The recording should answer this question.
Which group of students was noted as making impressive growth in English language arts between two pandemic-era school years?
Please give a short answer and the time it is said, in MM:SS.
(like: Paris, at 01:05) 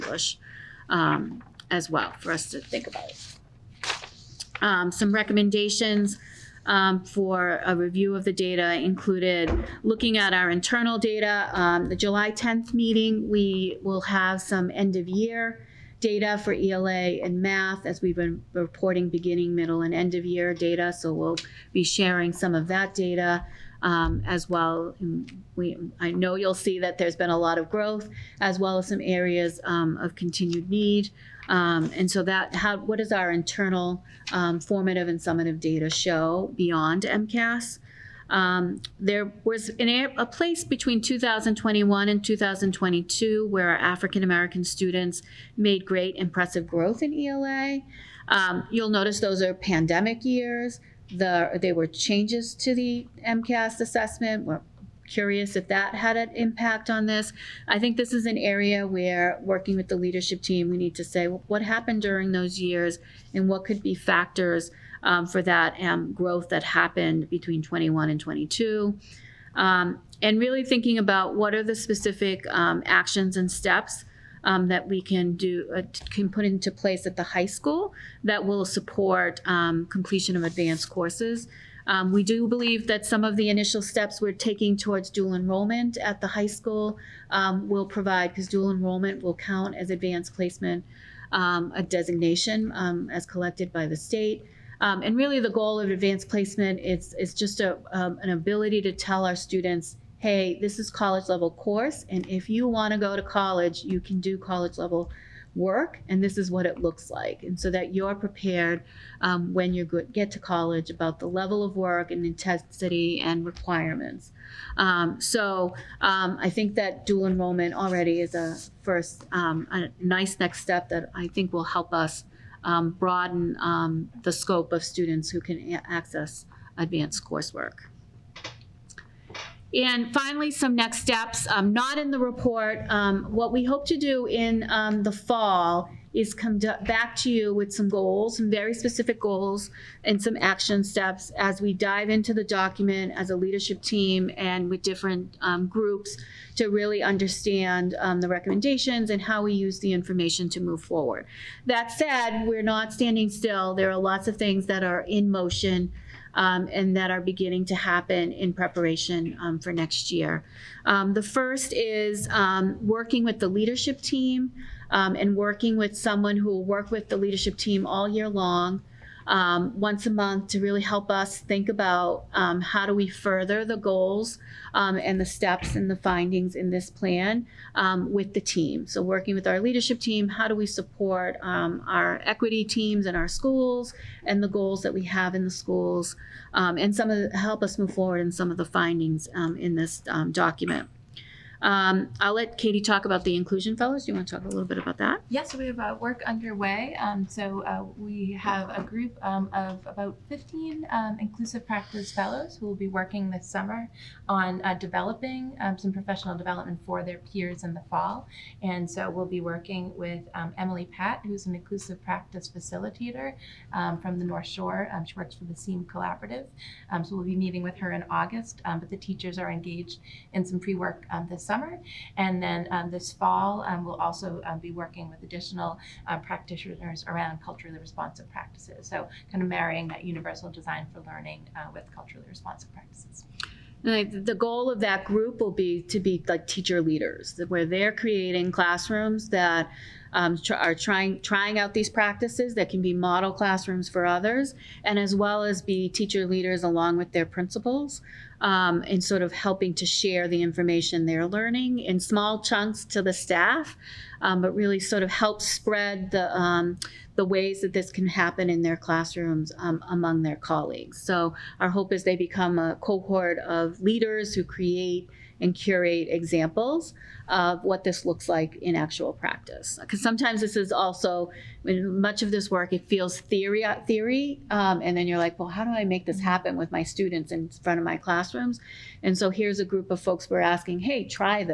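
African American students, at 00:43.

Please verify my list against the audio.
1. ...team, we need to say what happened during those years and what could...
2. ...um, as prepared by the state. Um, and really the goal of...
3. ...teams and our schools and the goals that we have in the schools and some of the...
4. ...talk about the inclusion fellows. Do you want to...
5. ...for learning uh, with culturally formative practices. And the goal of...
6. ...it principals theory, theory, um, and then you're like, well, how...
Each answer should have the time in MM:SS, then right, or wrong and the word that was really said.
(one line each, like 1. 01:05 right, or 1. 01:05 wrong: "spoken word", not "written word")
1. 01:00 right
2. 01:32 wrong: "collected", not "prepared"
3. 03:02 right
4. 03:12 right
5. 03:50 wrong: "responsive", not "formative"
6. 04:32 wrong: "feels", not "principals".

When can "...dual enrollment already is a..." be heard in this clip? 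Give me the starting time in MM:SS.
01:57.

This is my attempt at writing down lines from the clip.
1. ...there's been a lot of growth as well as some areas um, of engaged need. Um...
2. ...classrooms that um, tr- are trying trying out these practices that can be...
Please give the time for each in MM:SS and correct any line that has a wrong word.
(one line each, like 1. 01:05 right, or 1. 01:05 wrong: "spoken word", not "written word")
1. 00:26 wrong: "continued", not "engaged"
2. 03:58 right.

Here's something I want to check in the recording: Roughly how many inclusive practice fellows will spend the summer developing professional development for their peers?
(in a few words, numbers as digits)
15.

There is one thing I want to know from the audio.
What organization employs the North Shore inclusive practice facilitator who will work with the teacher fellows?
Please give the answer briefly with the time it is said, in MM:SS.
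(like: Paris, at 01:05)
SEEM Collaborative, at 03:35.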